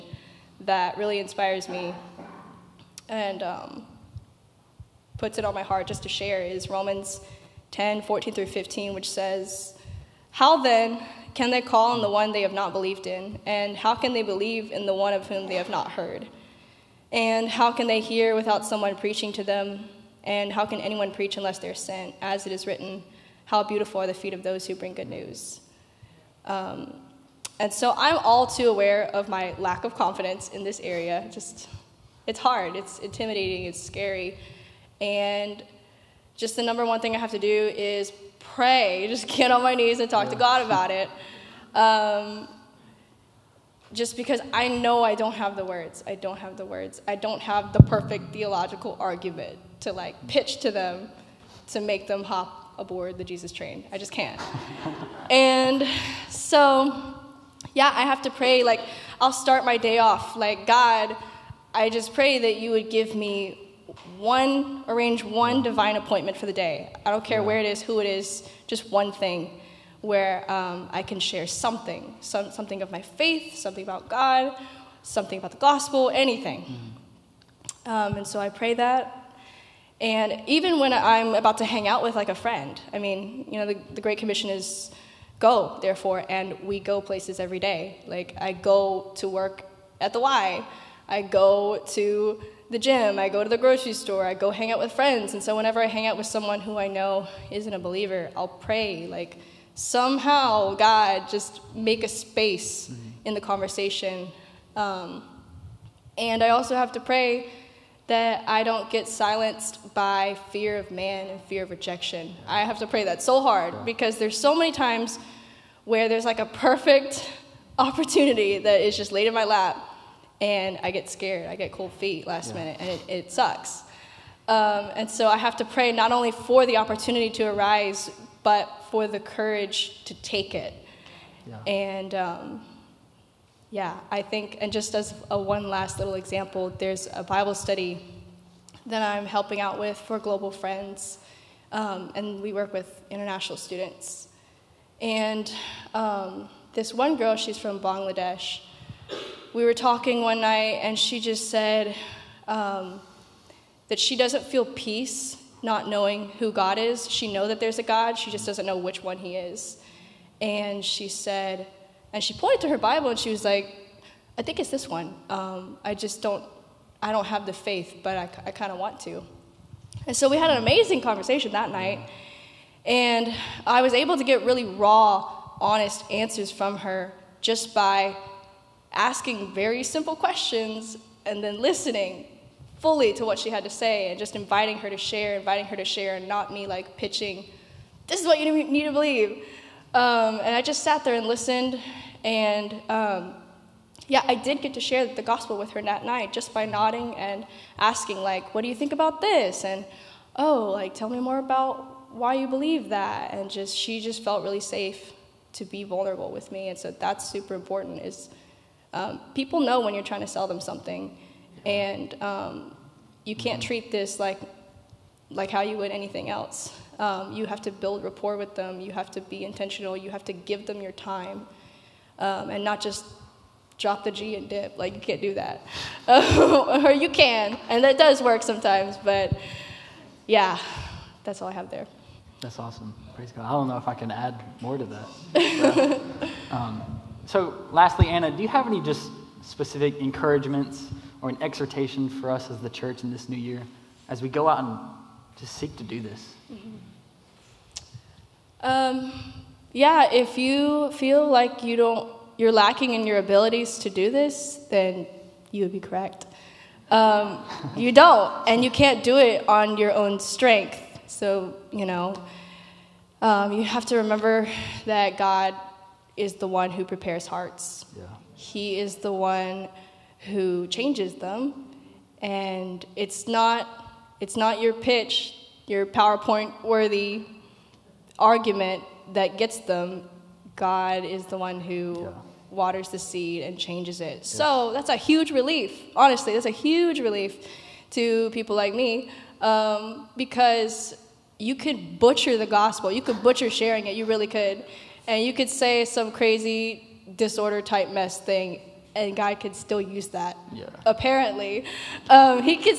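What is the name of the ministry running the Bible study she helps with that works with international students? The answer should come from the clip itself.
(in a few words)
Global Friends.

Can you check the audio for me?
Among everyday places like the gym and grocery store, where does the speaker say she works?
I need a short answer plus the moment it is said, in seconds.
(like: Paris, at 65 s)
the Y, at 90 s.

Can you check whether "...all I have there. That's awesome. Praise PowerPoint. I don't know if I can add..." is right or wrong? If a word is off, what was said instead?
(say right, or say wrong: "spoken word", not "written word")
wrong: "God", not "PowerPoint".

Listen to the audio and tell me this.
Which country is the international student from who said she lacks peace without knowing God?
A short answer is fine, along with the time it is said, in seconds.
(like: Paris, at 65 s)
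Bangladesh, at 147 s.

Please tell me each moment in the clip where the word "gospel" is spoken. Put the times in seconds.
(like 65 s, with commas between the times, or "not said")
75 s, 195 s, 292 s.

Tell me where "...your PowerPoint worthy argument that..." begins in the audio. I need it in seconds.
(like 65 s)
275 s.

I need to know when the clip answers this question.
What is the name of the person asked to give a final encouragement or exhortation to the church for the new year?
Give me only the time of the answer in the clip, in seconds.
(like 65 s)
238 s.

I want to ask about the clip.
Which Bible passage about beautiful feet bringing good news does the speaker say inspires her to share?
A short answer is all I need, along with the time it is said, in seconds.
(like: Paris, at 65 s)
Romans 10:14-15, at 6 s.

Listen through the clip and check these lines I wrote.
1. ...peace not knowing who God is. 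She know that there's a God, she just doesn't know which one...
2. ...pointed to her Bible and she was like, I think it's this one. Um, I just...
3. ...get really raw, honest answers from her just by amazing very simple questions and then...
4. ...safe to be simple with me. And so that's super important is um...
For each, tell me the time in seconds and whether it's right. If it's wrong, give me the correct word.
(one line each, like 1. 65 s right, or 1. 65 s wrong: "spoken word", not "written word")
1. 154 s right
2. 162 s right
3. 174 s wrong: "asking", not "amazing"
4. 204 s wrong: "vulnerable", not "simple".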